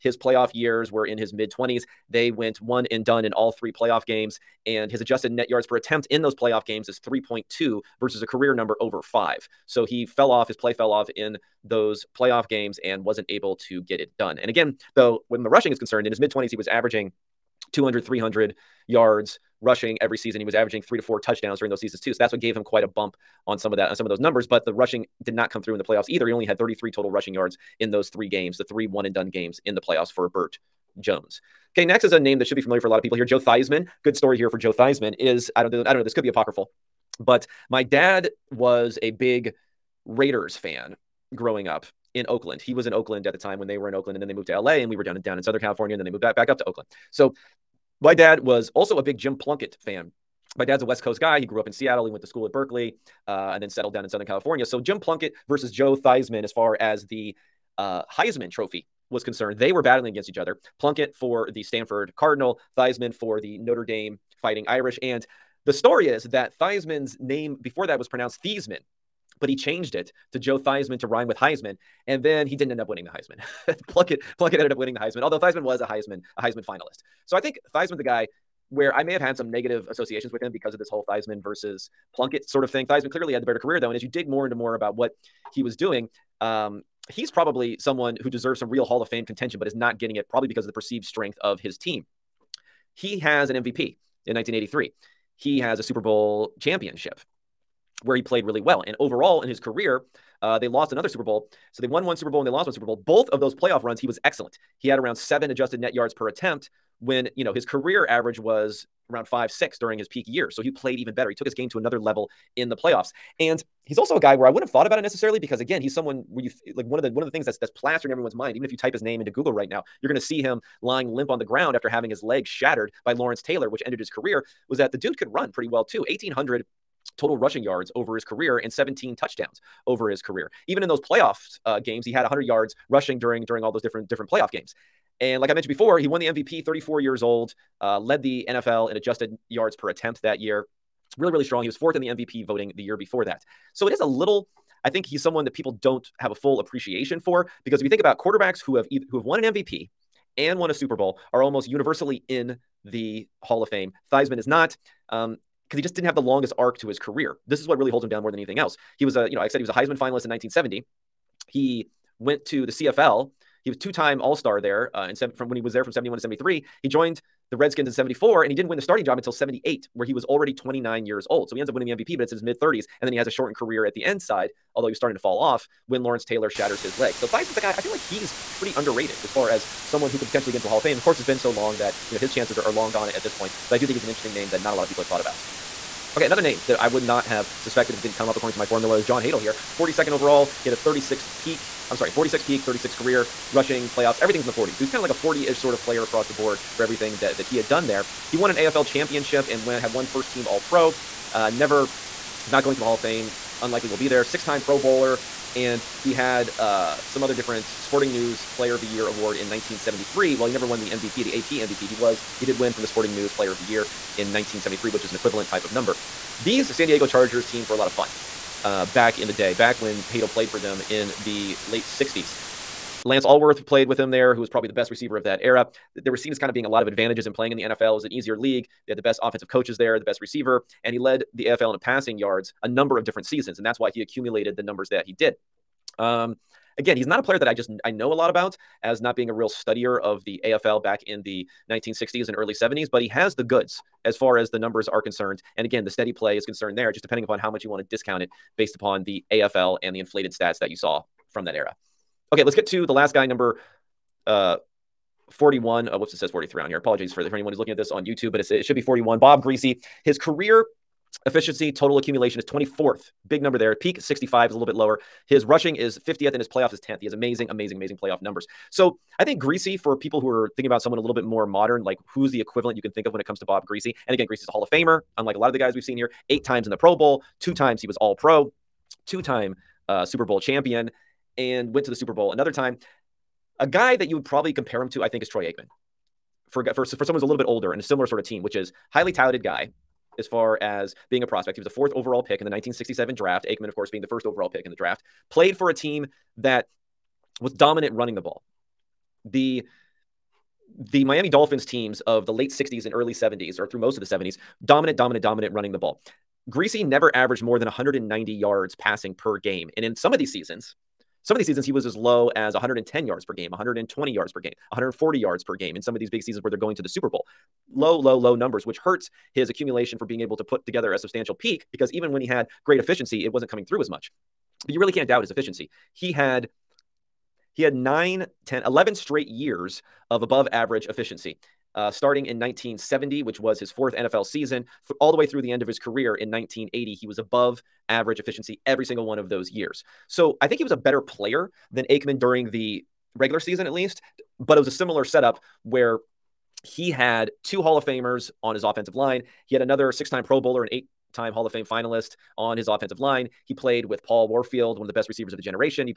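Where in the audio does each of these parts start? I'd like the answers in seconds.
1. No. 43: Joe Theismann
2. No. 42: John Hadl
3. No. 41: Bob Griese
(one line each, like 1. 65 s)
1. 31 s
2. 185 s
3. 252 s.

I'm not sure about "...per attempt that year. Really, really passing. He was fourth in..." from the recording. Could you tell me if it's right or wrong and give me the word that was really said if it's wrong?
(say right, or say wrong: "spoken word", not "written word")
wrong: "strong", not "passing".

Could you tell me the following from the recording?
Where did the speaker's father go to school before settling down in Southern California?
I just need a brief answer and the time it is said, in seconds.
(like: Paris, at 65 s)
Berkeley, at 52 s.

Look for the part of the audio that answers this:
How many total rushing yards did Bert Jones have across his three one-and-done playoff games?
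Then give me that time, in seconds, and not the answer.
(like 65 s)
26 s.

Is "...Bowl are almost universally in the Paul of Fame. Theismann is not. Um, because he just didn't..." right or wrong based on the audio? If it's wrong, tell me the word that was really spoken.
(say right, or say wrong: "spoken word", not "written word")
wrong: "Hall", not "Paul".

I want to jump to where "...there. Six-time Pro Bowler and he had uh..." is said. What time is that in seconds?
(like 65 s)
204 s.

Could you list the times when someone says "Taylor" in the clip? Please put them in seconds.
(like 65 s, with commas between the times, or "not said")
123 s, 176 s.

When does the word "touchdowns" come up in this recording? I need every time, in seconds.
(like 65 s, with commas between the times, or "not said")
21 s, 129 s.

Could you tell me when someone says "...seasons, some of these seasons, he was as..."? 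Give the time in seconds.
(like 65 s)
310 s.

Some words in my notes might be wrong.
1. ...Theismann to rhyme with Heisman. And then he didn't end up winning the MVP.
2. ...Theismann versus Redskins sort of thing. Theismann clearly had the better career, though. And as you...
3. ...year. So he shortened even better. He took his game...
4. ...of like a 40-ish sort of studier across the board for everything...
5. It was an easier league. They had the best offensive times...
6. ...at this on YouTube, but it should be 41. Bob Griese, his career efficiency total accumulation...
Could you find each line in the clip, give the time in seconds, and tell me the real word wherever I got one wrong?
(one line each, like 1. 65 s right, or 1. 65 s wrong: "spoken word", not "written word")
1. 70 s wrong: "Heisman", not "MVP"
2. 81 s wrong: "Plunkett", not "Redskins"
3. 110 s wrong: "played", not "shortened"
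4. 194 s wrong: "player", not "studier"
5. 227 s wrong: "coaches", not "times"
6. 257 s right.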